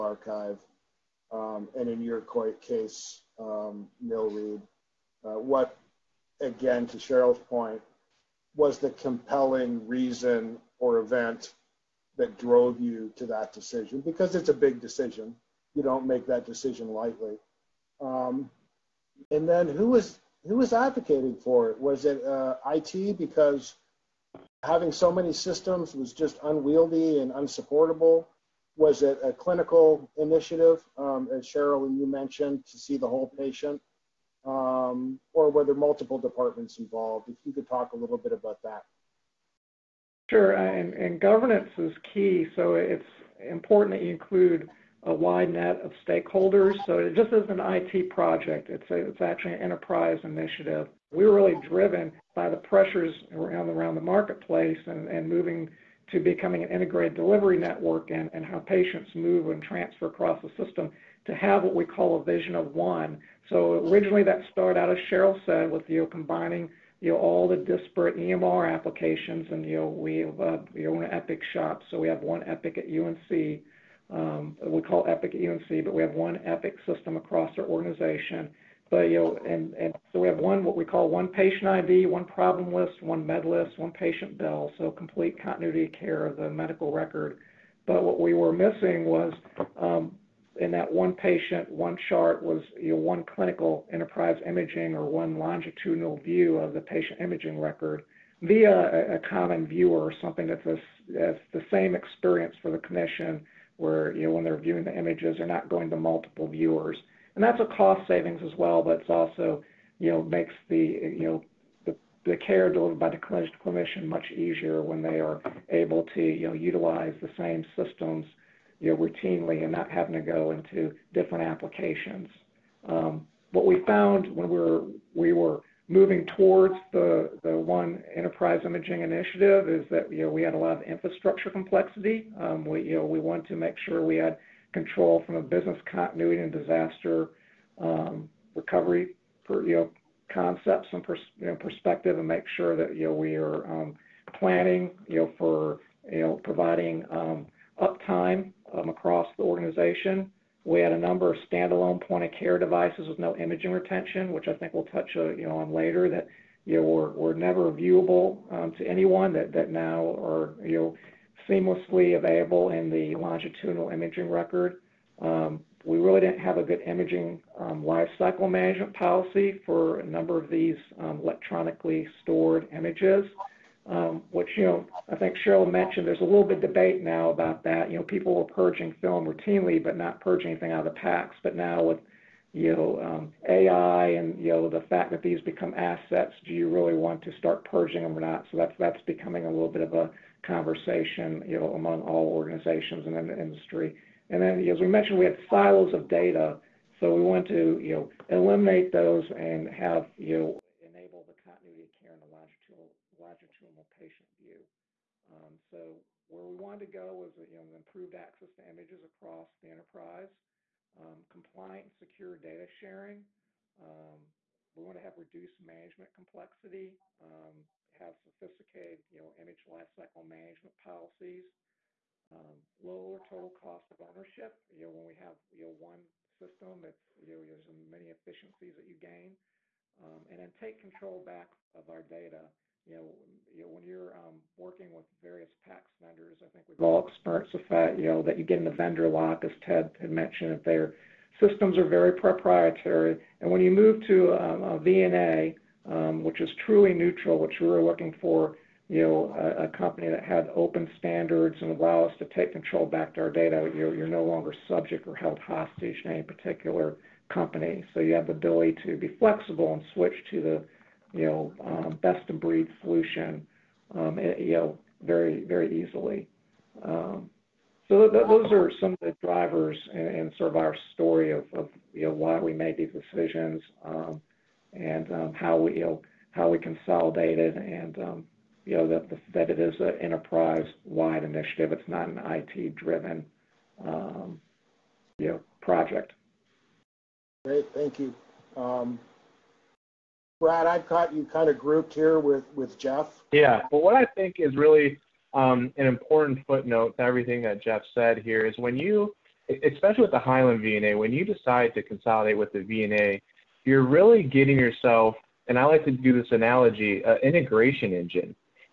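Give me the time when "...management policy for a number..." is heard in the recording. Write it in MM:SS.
02:48.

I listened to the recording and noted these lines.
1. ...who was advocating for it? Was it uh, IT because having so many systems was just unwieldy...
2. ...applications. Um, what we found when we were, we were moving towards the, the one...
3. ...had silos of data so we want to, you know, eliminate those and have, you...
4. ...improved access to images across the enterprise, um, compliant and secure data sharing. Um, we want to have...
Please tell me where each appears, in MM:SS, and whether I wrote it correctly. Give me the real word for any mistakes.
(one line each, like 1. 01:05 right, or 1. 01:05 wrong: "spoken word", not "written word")
1. 00:20 right
2. 02:01 right
3. 03:15 right
4. 03:27 right.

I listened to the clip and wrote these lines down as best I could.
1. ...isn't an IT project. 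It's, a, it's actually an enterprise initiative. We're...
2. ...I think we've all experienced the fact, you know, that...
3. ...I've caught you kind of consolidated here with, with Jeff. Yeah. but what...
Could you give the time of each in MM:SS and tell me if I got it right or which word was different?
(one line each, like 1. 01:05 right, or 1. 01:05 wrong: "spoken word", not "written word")
1. 00:47 right
2. 03:56 right
3. 04:50 wrong: "grouped", not "consolidated".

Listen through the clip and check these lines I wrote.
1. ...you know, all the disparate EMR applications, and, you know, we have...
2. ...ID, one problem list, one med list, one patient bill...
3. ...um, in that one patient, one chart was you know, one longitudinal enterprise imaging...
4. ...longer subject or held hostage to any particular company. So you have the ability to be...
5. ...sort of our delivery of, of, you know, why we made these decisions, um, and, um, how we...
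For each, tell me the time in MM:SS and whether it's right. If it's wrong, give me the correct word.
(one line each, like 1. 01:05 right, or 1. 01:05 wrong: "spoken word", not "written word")
1. 01:07 right
2. 01:21 right
3. 01:29 wrong: "clinical", not "longitudinal"
4. 04:14 right
5. 04:30 wrong: "story", not "delivery".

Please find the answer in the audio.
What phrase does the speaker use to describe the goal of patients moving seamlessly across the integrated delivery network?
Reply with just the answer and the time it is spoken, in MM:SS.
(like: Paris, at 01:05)
vision of one, at 01:02.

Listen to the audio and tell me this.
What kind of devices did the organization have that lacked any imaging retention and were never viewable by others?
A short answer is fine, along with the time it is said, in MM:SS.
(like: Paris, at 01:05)
point-of-care devices, at 02:32.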